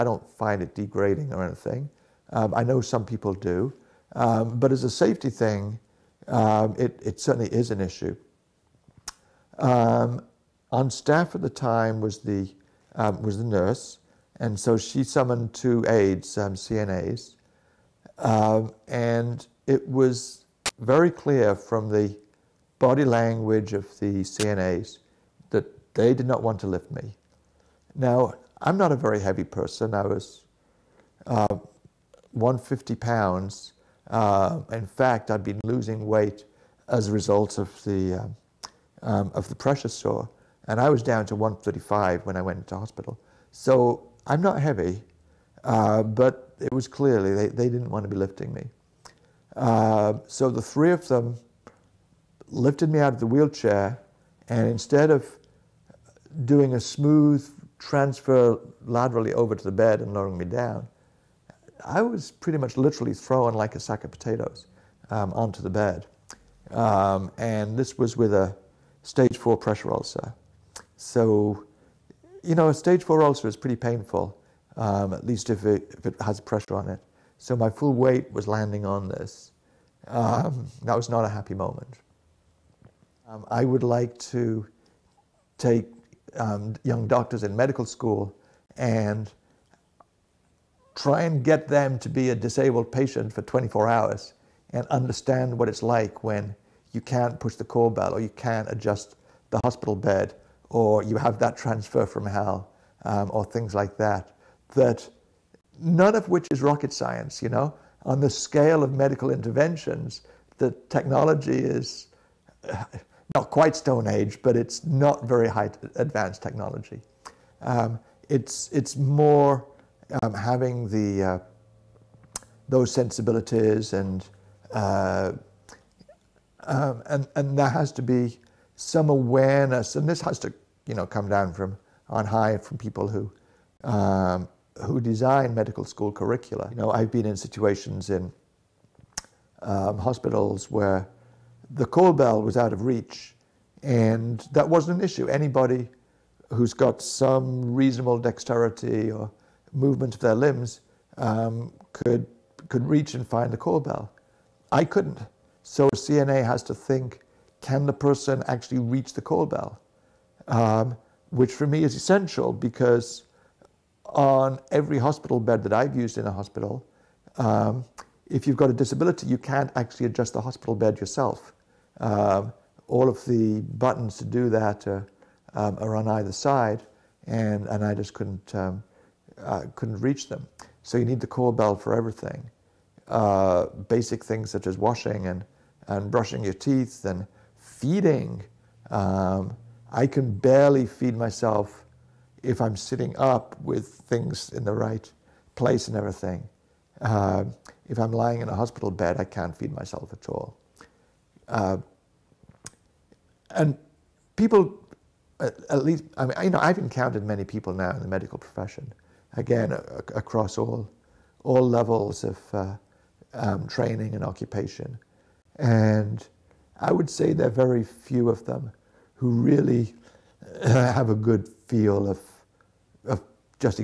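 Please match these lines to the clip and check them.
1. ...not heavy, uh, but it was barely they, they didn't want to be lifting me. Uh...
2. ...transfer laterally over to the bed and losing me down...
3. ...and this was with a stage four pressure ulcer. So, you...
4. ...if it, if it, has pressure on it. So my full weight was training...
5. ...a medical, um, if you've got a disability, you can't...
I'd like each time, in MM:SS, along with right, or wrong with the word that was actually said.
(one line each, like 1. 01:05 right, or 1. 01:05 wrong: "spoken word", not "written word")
1. 00:44 wrong: "clearly", not "barely"
2. 00:57 wrong: "lowering", not "losing"
3. 01:07 right
4. 01:15 wrong: "landing", not "training"
5. 02:46 wrong: "hospital", not "medical".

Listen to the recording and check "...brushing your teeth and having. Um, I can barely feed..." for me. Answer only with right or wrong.
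wrong.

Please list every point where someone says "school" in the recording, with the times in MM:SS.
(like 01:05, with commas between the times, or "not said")
01:27, 02:15.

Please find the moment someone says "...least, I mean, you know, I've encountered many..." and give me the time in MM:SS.
03:25.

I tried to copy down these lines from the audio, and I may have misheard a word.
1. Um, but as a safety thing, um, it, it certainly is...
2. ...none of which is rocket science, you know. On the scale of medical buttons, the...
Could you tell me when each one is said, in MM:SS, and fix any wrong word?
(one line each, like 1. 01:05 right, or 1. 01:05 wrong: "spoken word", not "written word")
1. 00:04 right
2. 01:45 wrong: "interventions", not "buttons".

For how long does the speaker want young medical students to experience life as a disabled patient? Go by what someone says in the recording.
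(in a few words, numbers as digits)
24 hours.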